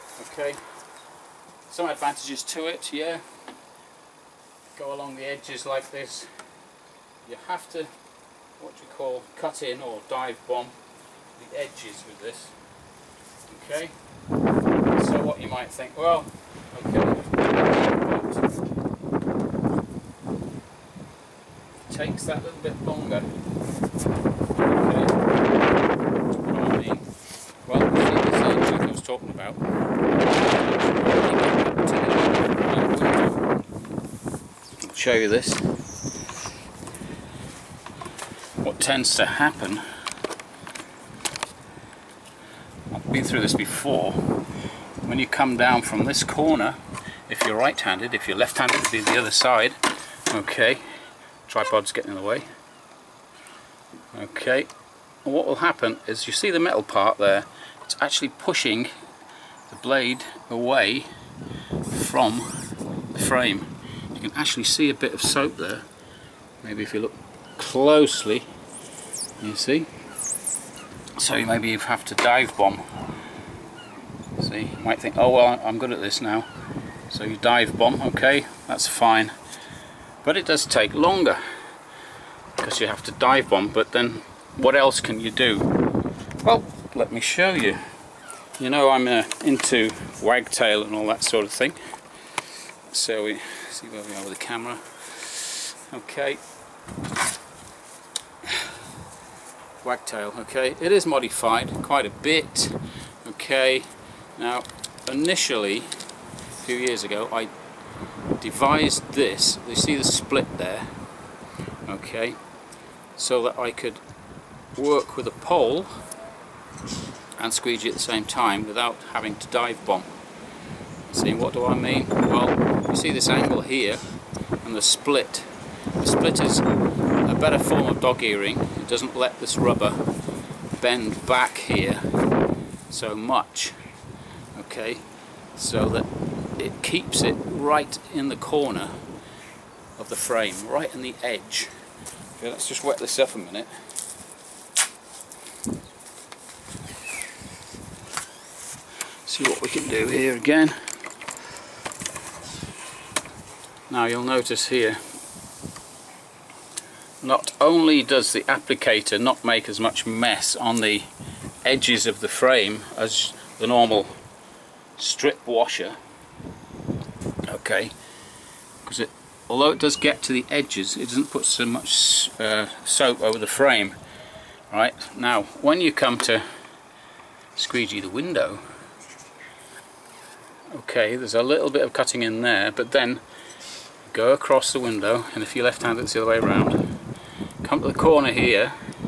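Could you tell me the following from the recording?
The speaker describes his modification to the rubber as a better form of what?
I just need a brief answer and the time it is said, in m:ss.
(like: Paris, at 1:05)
Dog earring, at 2:08.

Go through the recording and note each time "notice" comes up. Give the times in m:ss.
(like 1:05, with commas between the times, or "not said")
2:34.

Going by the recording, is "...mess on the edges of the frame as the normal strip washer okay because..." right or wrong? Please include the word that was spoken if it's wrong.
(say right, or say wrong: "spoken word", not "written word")
right.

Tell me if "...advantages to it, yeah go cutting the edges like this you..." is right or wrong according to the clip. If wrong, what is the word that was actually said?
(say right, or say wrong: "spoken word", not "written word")
wrong: "along", not "cutting".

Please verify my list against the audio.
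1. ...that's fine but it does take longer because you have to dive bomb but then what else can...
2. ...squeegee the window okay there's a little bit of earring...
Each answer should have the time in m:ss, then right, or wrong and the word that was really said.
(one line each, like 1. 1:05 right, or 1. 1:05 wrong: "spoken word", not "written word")
1. 1:18 right
2. 2:57 wrong: "cutting", not "earring".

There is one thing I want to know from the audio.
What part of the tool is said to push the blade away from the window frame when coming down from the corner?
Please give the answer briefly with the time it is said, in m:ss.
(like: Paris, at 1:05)
The metal part, at 0:56.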